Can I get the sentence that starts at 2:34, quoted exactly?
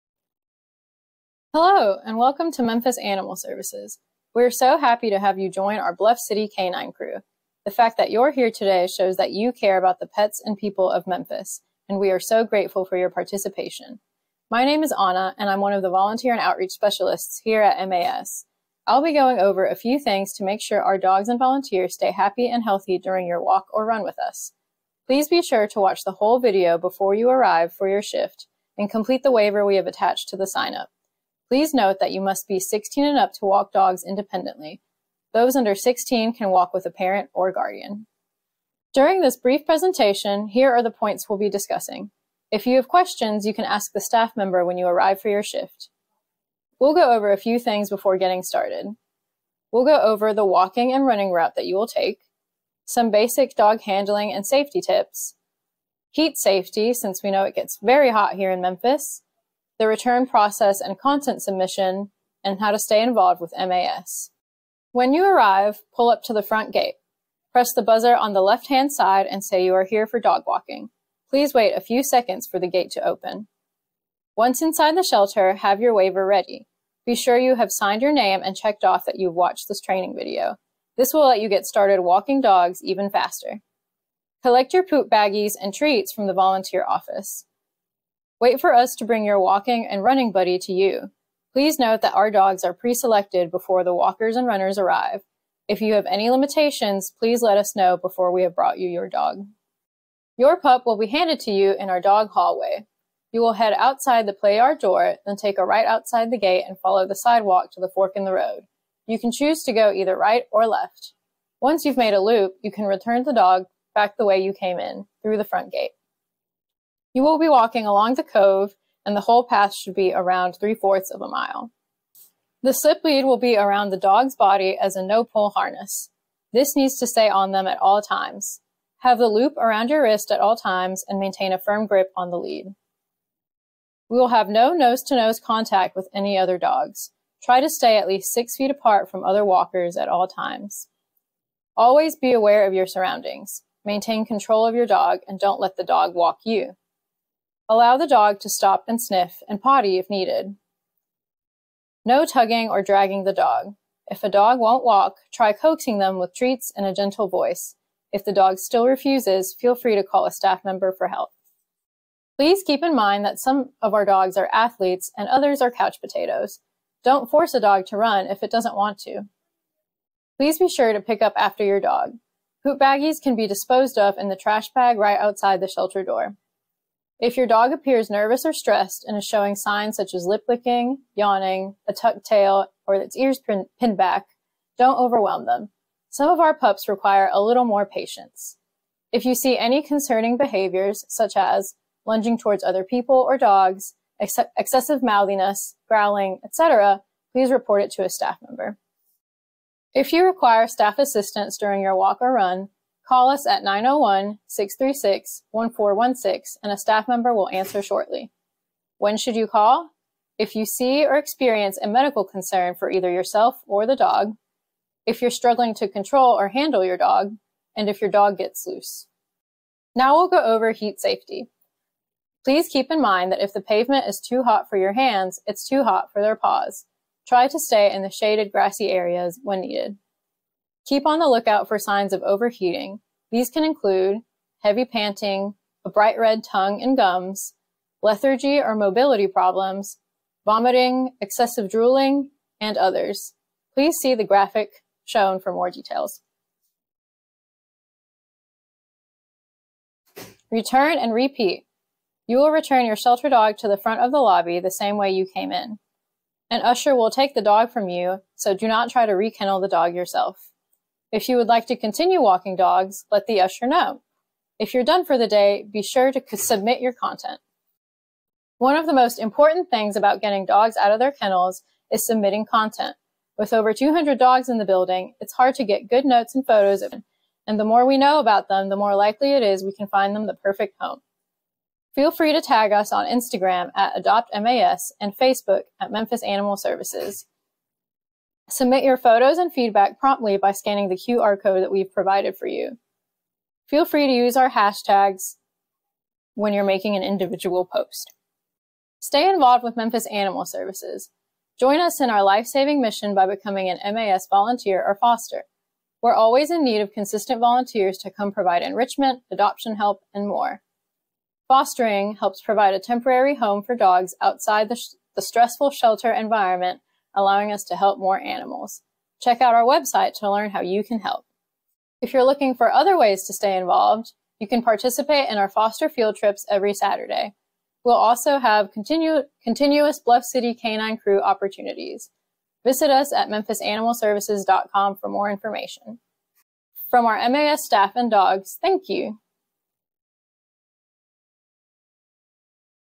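If a dog won't walk, try coaxing them with treats and a gentle voice.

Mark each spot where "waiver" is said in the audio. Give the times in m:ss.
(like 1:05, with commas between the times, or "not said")
0:29, 1:15.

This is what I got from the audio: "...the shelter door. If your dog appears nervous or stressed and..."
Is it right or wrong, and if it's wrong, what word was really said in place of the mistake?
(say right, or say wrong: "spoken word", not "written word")
right.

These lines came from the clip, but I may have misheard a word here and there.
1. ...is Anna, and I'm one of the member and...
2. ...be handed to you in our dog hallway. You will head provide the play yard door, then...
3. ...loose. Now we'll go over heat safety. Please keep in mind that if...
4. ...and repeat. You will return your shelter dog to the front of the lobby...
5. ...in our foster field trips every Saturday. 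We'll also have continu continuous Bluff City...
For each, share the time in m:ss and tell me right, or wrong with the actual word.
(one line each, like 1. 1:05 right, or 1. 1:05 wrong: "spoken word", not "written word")
1. 0:14 wrong: "volunteer", not "member"
2. 1:40 wrong: "outside", not "provide"
3. 3:38 right
4. 4:10 right
5. 5:25 right.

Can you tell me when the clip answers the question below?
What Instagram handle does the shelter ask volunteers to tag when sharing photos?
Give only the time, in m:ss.
4:44.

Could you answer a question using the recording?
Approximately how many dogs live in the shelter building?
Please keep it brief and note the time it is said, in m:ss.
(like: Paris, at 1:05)
Over 200, at 4:33.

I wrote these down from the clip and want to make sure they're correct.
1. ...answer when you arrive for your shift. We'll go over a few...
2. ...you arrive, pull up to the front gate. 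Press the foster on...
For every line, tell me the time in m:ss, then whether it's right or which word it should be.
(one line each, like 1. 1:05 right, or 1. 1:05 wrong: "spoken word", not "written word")
1. 0:44 wrong: "member", not "answer"
2. 1:05 wrong: "buzzer", not "foster".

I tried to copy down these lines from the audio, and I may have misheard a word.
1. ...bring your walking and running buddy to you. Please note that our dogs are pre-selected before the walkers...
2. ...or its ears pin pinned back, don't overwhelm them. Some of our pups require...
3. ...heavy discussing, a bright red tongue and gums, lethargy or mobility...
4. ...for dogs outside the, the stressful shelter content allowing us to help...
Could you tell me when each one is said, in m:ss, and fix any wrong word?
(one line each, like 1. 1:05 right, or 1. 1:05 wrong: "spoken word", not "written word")
1. 1:29 right
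2. 3:02 right
3. 3:54 wrong: "panting", not "discussing"
4. 5:13 wrong: "environment", not "content".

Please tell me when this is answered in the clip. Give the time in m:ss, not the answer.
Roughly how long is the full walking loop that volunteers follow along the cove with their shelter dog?
2:00.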